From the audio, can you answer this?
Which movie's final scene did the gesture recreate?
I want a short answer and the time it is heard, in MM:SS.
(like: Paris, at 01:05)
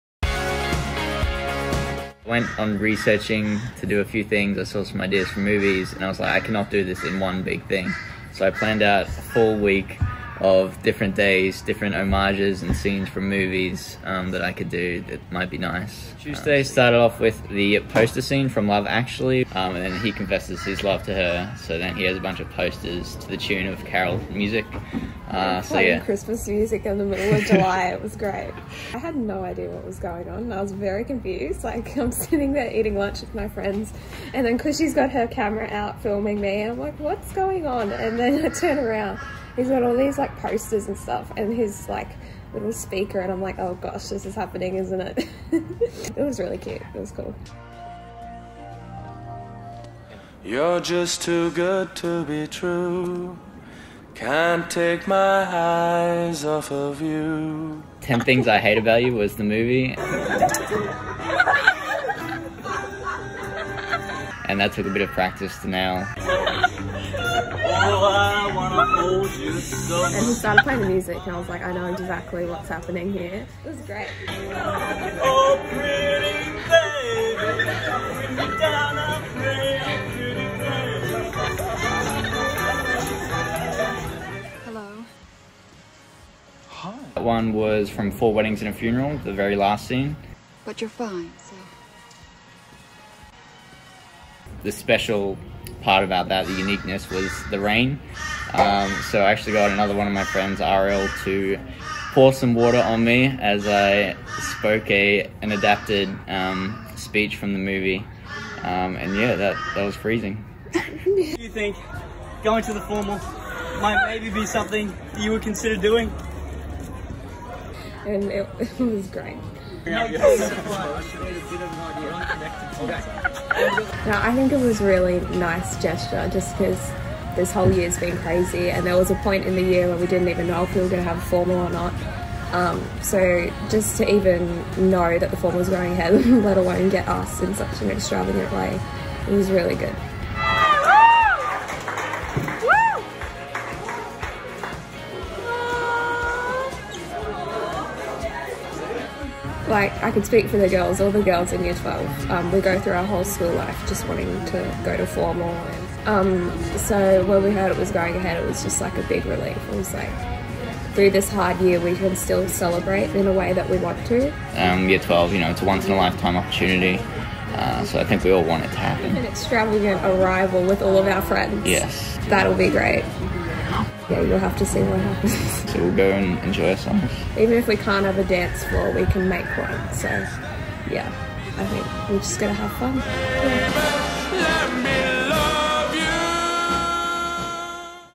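Four Weddings and a Funeral, at 01:28.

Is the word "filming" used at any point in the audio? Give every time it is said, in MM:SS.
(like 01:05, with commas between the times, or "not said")
00:36.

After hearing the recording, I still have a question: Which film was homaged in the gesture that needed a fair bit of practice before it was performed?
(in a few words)
10 Things I Hate About You.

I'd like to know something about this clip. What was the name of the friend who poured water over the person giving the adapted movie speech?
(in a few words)
RL.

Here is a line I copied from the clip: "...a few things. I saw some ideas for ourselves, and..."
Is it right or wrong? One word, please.
wrong.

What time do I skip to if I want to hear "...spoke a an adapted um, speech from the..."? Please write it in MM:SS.
01:44.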